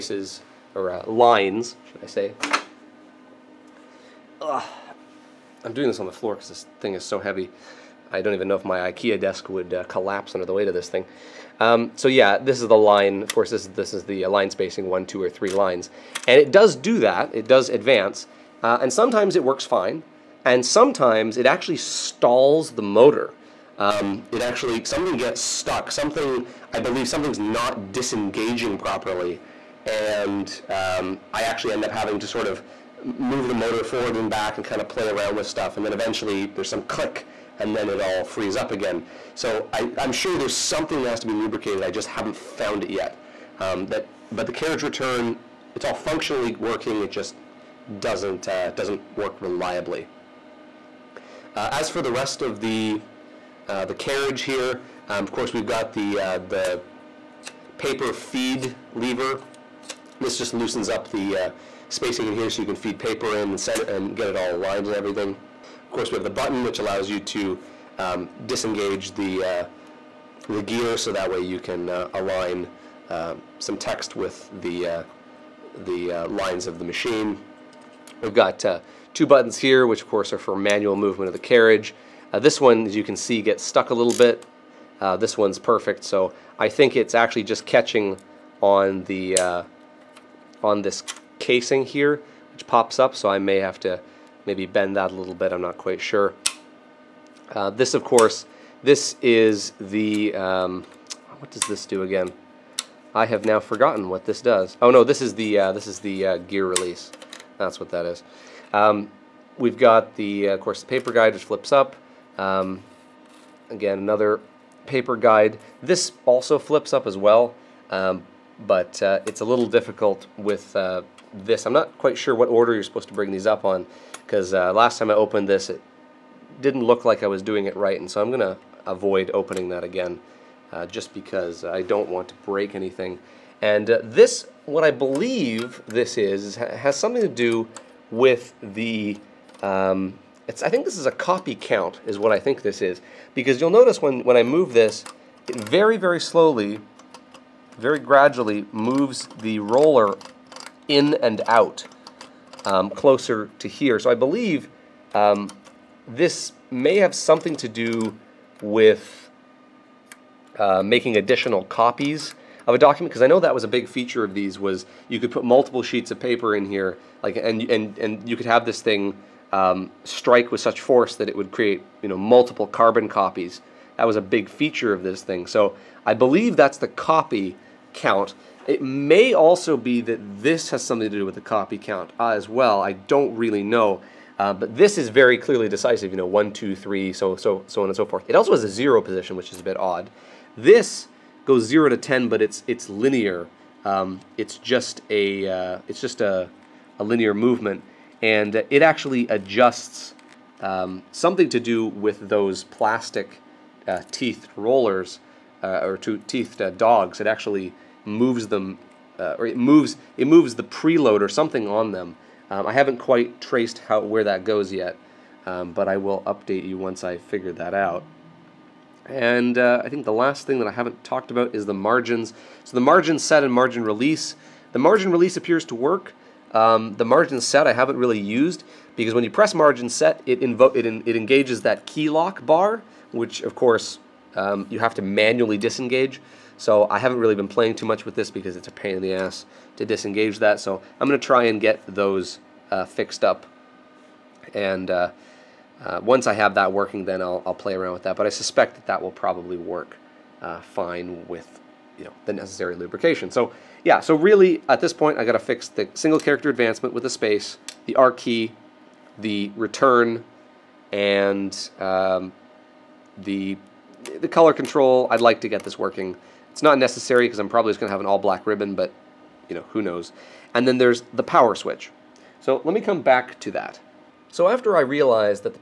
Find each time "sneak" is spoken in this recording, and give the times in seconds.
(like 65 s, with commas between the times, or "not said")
not said.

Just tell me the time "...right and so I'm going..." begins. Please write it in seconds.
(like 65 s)
127 s.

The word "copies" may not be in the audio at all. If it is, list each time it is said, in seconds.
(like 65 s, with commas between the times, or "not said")
161 s, 173 s.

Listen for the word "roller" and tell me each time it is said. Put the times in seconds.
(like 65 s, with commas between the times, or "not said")
149 s, 204 s.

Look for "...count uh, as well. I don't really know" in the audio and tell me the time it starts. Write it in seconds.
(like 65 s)
181 s.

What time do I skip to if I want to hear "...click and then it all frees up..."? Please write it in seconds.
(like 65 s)
36 s.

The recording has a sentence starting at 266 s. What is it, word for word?
It's not necessary because I'm probably just going to have an all black ribbon, but you know, who knows.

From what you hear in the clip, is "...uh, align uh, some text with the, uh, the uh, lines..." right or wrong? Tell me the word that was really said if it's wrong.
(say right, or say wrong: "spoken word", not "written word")
right.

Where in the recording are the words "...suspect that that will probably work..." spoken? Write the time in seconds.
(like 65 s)
248 s.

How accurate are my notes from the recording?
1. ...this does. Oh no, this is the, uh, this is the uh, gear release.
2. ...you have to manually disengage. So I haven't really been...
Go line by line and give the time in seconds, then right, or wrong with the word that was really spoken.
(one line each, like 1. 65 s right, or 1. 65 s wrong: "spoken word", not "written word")
1. 104 s right
2. 234 s right.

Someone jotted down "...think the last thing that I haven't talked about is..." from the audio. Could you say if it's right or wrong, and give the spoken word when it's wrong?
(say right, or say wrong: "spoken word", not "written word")
right.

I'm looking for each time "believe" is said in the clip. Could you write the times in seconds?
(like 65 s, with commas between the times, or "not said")
26 s, 134 s, 154 s, 176 s.